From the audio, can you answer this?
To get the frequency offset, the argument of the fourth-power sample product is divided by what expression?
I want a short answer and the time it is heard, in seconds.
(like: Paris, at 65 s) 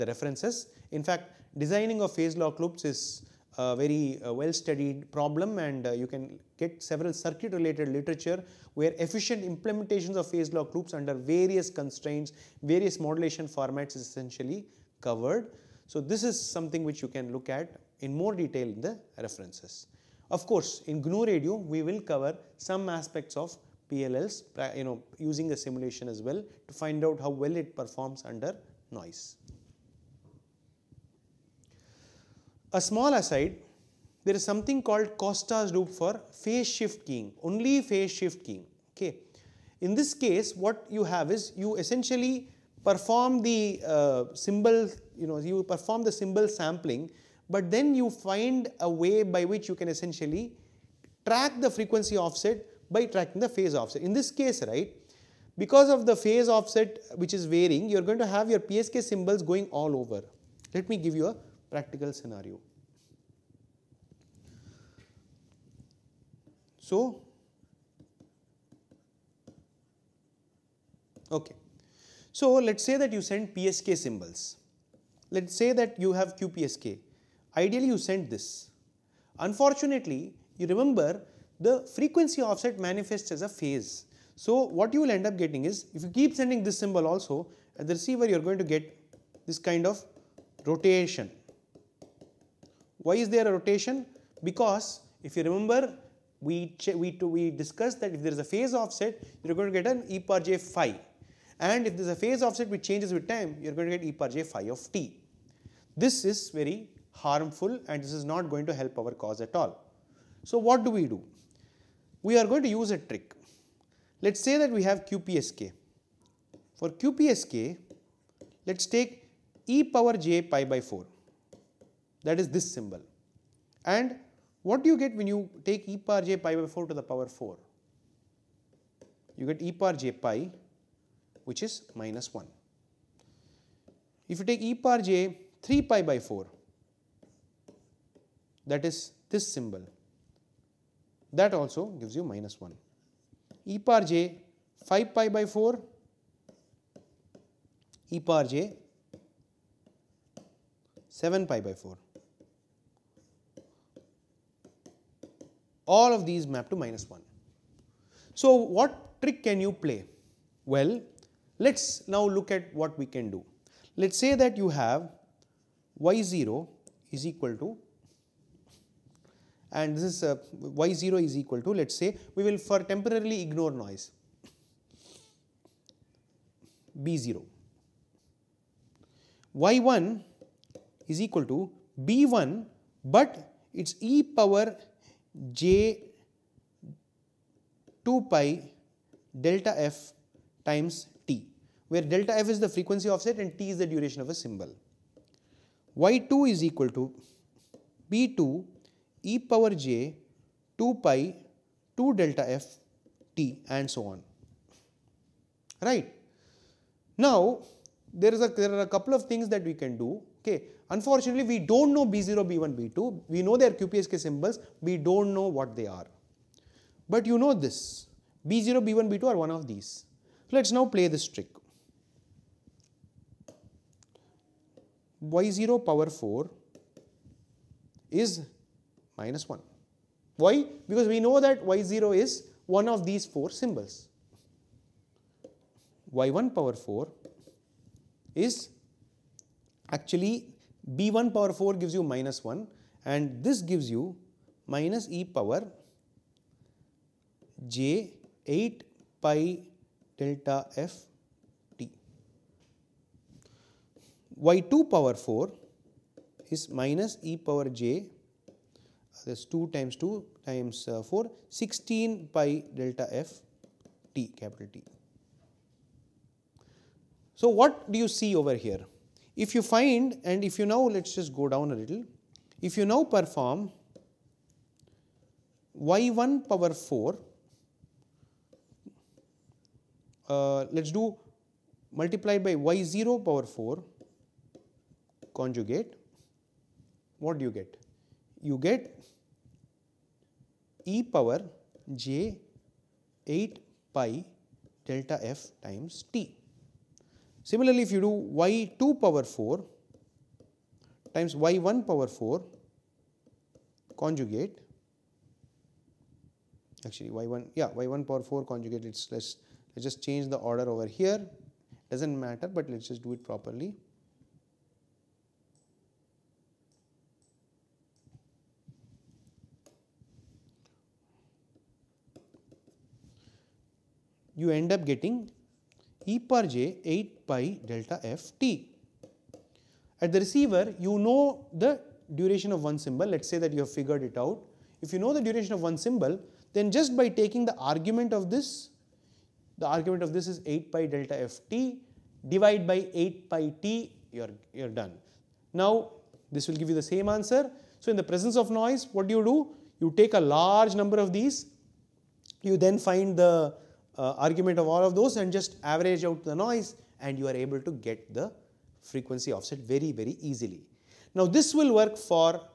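8 pi T, at 342 s.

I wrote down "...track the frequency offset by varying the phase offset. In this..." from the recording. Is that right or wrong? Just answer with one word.
wrong.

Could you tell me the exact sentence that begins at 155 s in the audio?
All of these map to minus 1.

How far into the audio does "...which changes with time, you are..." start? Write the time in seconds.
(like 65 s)
102 s.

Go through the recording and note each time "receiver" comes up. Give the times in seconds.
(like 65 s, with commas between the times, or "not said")
87 s, 330 s.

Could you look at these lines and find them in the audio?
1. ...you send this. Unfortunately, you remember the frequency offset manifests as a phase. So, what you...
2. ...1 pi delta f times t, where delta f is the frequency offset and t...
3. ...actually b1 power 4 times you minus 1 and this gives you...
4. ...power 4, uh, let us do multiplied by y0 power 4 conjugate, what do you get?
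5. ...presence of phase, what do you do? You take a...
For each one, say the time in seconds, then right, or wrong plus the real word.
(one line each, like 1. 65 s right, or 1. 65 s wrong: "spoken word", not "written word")
1. 77 s right
2. 188 s wrong: "2", not "1"
3. 239 s wrong: "gives", not "times"
4. 276 s right
5. 348 s wrong: "noise", not "phase".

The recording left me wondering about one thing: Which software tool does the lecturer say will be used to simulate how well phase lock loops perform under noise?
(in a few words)
GNU Radio.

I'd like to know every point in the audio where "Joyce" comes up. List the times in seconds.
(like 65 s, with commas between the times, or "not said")
not said.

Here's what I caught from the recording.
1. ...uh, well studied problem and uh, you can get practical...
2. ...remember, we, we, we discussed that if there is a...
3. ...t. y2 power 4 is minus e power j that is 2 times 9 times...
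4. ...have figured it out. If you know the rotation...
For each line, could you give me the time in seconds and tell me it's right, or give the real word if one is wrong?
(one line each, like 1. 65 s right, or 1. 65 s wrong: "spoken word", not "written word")
1. 4 s wrong: "several", not "practical"
2. 95 s right
3. 251 s wrong: "2", not "9"
4. 333 s wrong: "duration", not "rotation".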